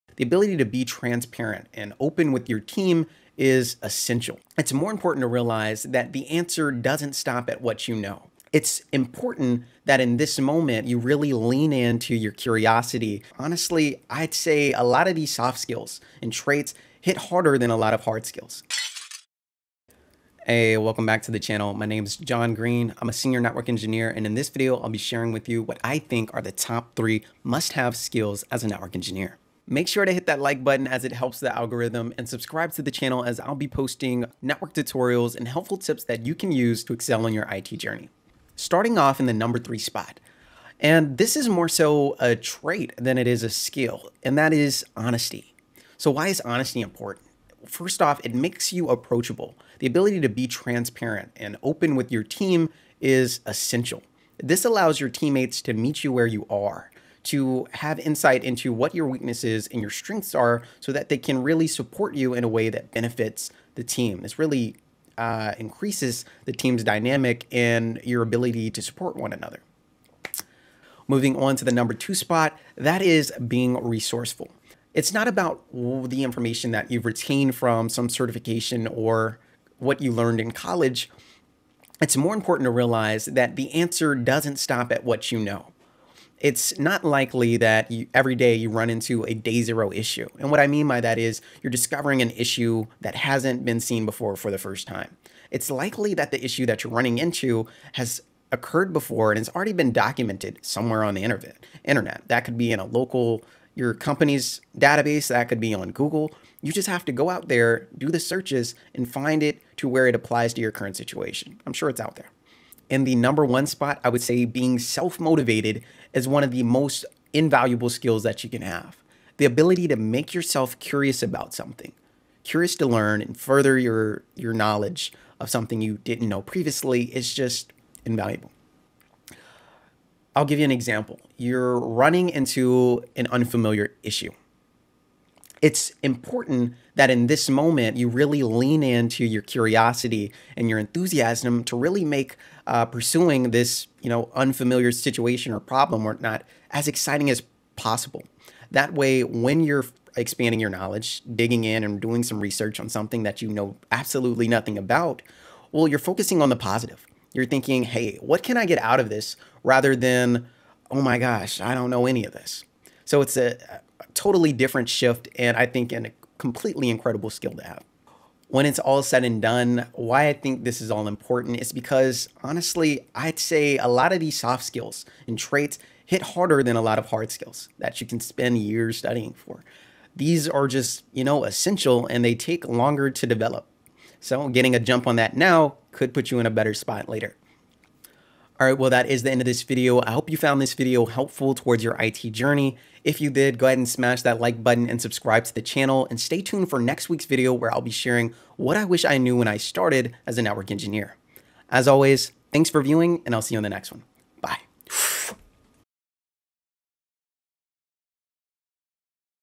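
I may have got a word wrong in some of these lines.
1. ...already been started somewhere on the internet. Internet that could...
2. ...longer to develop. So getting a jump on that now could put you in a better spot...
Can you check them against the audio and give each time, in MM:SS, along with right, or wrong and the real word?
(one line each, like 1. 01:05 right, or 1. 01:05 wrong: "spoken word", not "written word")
1. 01:39 wrong: "documented", not "started"
2. 03:02 right.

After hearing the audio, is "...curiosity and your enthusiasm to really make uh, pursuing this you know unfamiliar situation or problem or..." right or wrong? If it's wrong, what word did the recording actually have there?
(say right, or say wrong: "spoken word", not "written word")
right.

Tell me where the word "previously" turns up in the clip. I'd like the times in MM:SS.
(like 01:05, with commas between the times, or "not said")
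02:06.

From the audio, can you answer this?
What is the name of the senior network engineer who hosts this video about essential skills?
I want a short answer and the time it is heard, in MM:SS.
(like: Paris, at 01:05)
Jon Green, at 00:22.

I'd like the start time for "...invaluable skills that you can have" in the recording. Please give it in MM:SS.
01:57.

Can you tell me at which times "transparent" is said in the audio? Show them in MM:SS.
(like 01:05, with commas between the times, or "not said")
00:00, 00:50.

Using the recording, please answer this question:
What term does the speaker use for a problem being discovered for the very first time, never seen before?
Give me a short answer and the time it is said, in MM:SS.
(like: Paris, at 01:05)
day zero issue, at 01:29.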